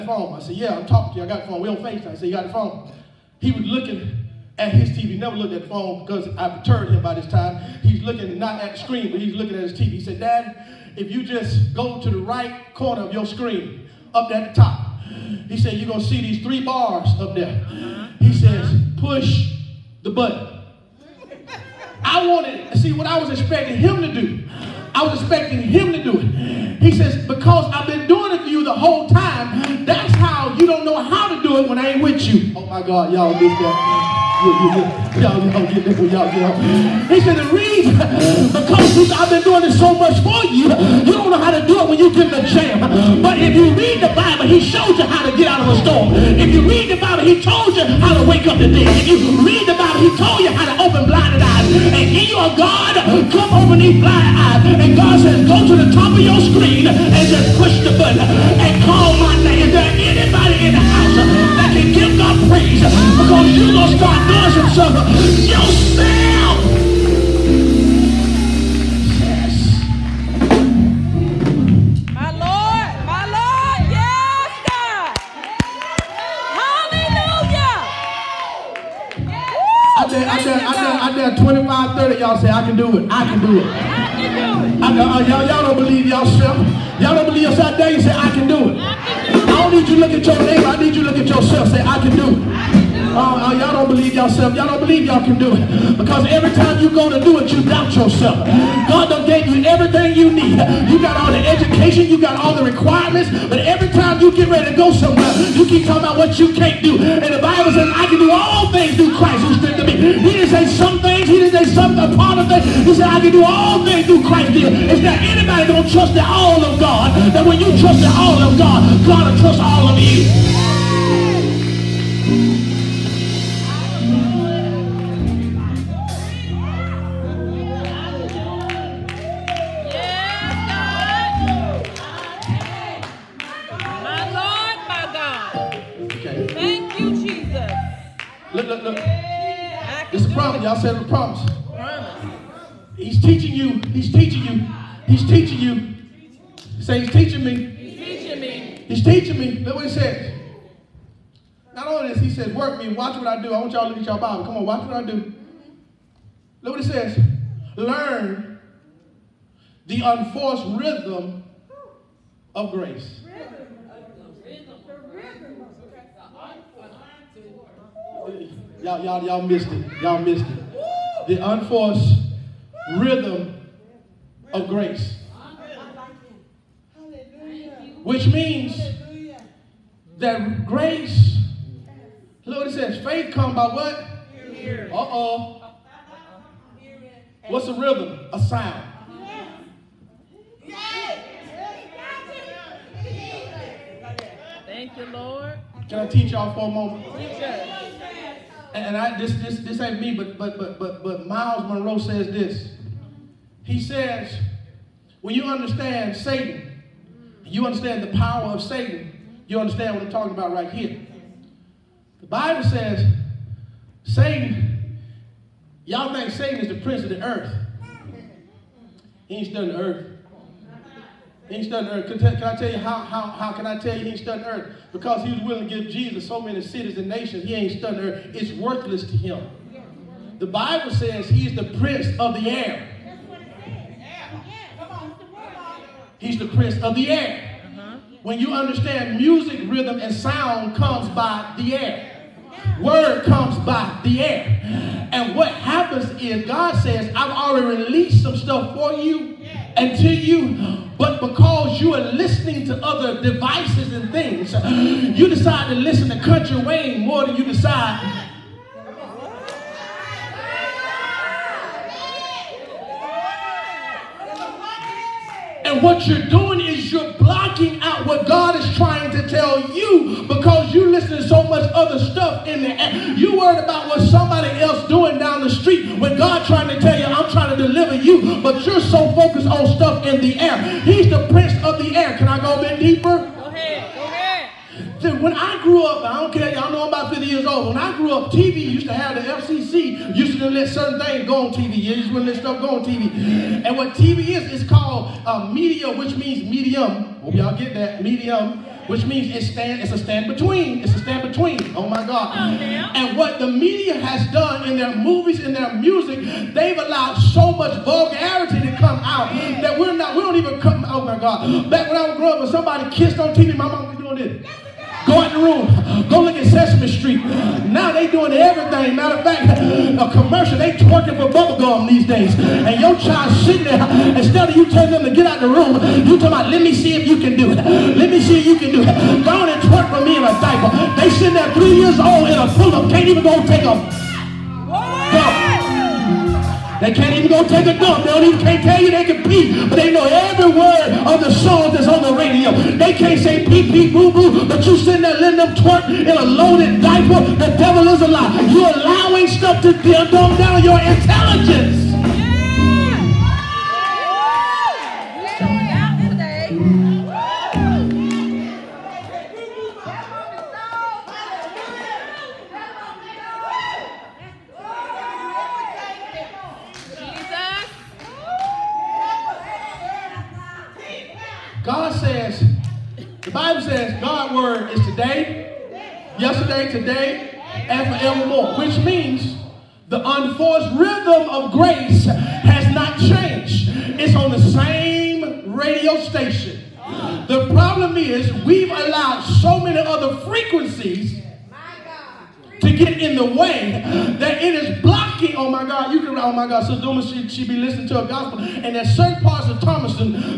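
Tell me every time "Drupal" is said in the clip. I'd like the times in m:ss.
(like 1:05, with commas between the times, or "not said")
not said.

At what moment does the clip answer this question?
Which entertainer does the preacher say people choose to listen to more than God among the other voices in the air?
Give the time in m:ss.
4:16.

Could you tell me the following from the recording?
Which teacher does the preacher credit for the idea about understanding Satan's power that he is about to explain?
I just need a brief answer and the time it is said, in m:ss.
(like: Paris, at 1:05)
Myles Munroe, at 3:21.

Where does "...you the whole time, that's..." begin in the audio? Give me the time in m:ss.
0:28.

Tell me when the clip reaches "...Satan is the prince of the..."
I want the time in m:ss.
3:36.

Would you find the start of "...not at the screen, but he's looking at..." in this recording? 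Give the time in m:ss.
0:08.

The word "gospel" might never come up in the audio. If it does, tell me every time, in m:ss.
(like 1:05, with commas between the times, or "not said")
6:38.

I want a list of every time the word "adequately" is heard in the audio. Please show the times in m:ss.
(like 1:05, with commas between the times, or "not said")
not said.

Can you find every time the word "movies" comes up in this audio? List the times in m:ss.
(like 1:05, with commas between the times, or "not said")
5:04.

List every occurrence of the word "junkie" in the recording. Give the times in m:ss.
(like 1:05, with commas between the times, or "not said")
not said.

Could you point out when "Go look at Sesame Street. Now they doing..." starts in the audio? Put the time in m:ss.
5:16.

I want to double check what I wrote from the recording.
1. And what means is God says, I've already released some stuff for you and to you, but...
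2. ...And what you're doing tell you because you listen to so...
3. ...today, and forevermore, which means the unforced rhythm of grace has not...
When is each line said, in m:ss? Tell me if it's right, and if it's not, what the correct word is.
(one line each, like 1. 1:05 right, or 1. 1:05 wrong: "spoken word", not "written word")
1. 4:05 wrong: "happens", not "means"
2. 4:25 right
3. 6:16 right.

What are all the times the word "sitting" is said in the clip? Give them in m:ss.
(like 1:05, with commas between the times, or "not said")
5:23, 5:31, 5:44.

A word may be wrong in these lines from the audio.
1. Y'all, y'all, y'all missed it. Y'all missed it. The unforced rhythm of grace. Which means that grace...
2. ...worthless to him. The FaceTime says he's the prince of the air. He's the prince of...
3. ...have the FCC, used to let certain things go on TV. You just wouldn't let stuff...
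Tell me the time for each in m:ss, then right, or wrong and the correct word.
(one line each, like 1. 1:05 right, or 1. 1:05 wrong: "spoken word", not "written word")
1. 2:48 right
2. 3:48 wrong: "Bible", not "FaceTime"
3. 4:48 right.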